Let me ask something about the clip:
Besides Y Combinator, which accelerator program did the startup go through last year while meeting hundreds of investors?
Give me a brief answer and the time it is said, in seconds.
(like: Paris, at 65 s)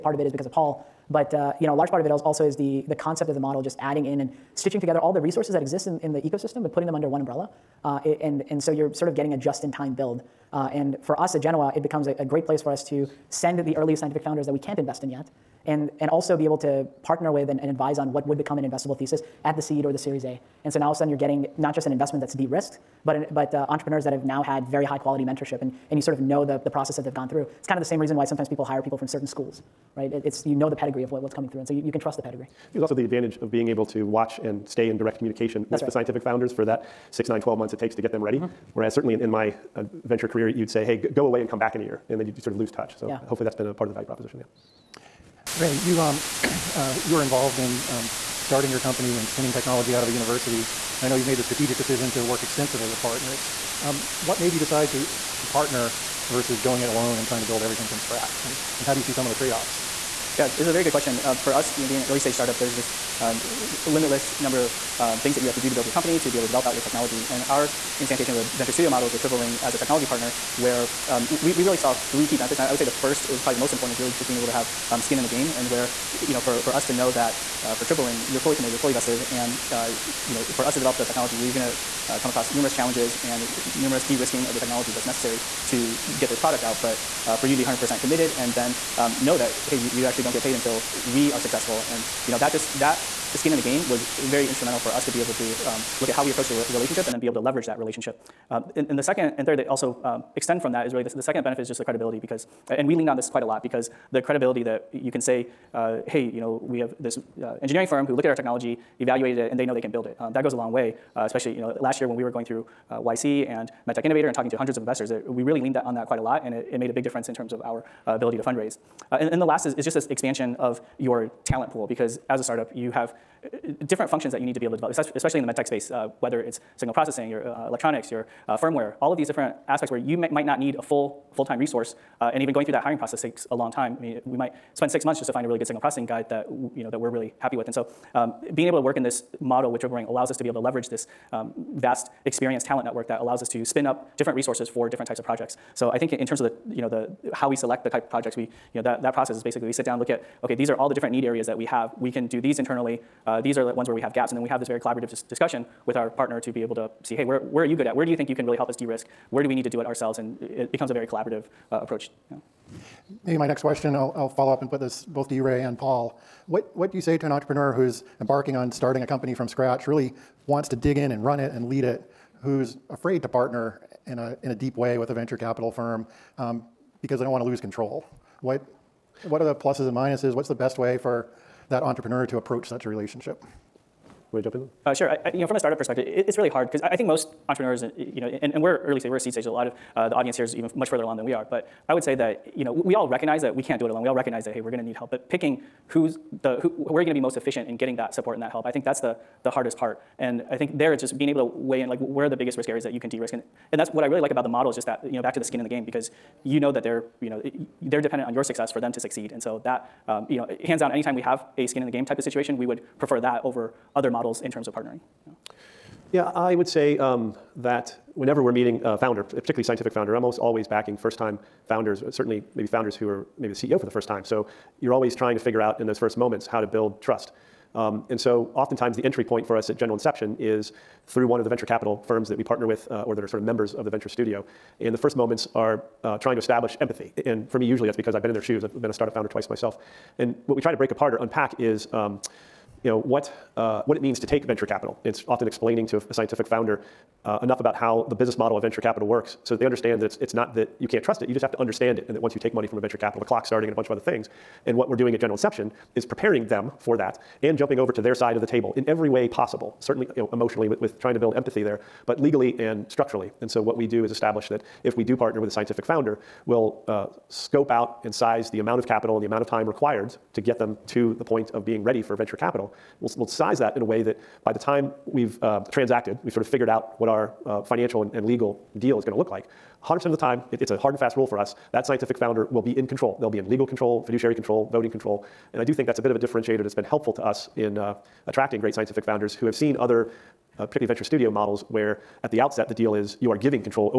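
MedTech Innovator, at 113 s.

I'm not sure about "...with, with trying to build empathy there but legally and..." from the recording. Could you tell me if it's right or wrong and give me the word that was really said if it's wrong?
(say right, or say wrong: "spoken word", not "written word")
right.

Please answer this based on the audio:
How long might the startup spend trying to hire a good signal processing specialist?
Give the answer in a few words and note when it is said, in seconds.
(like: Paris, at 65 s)
6 months, at 134 s.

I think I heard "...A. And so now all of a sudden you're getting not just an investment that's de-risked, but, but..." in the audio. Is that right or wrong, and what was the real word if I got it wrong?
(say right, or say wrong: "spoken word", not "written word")
right.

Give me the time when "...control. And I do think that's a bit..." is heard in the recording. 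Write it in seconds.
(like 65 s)
284 s.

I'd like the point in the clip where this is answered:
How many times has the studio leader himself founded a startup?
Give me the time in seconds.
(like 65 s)
239 s.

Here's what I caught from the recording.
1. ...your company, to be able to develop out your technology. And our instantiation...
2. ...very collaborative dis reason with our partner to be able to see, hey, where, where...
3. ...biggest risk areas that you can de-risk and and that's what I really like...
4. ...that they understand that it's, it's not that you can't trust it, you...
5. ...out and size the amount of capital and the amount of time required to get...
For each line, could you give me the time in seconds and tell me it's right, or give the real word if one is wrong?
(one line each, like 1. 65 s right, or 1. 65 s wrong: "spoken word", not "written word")
1. 65 s right
2. 154 s wrong: "discussion", not "reason"
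3. 202 s right
4. 249 s right
5. 267 s right.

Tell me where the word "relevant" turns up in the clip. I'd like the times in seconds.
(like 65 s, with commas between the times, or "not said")
not said.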